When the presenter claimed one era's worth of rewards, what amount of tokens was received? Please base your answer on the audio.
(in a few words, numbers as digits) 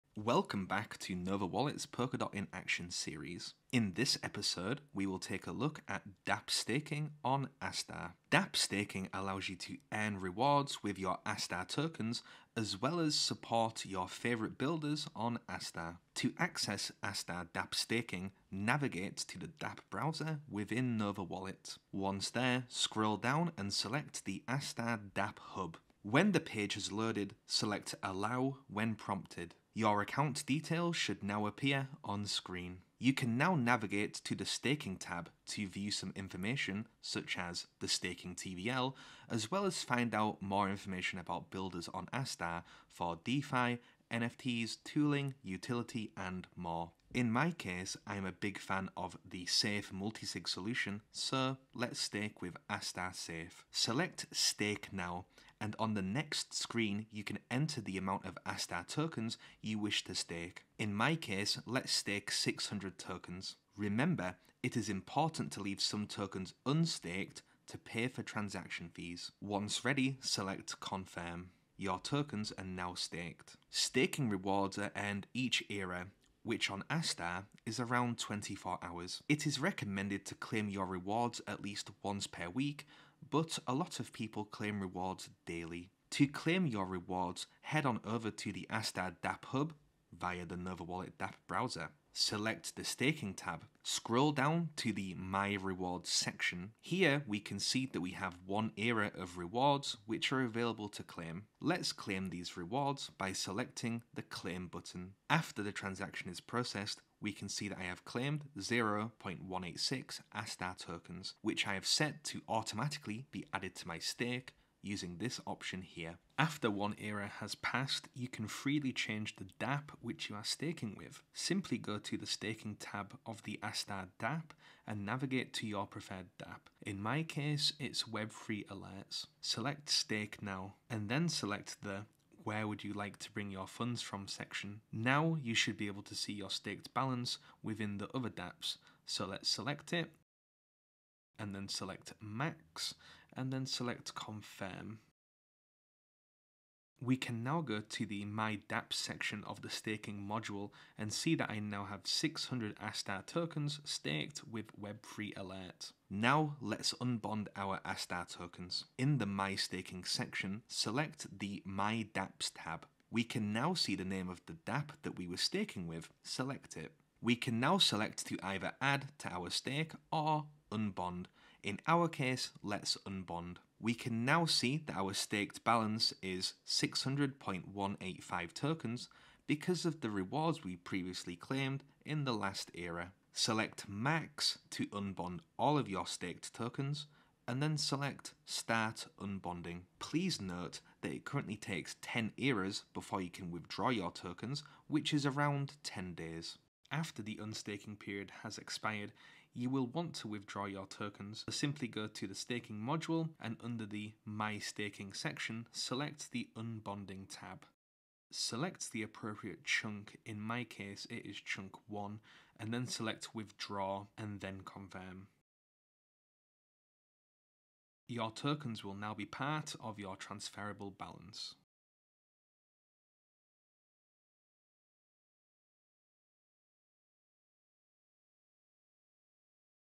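0.186.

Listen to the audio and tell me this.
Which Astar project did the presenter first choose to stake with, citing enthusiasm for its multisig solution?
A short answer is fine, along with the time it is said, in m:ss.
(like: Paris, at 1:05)
Astar Safe, at 0:52.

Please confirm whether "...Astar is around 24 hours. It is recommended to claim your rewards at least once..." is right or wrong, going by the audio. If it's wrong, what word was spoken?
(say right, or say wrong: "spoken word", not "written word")
right.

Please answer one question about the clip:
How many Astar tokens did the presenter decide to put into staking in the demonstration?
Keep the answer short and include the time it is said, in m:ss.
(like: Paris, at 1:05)
600, at 1:02.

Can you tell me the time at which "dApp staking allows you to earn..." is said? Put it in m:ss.
0:08.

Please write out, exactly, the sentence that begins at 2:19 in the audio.
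So let's select it and then select max and then select confirm.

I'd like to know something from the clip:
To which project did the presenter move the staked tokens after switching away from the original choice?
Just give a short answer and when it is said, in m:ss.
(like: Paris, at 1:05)
Web3 Alerts, at 2:08.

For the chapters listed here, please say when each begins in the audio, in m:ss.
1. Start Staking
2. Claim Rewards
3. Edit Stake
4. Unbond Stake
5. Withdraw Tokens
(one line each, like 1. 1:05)
1. 0:16
2. 1:26
3. 1:56
4. 2:36
5. 3:16.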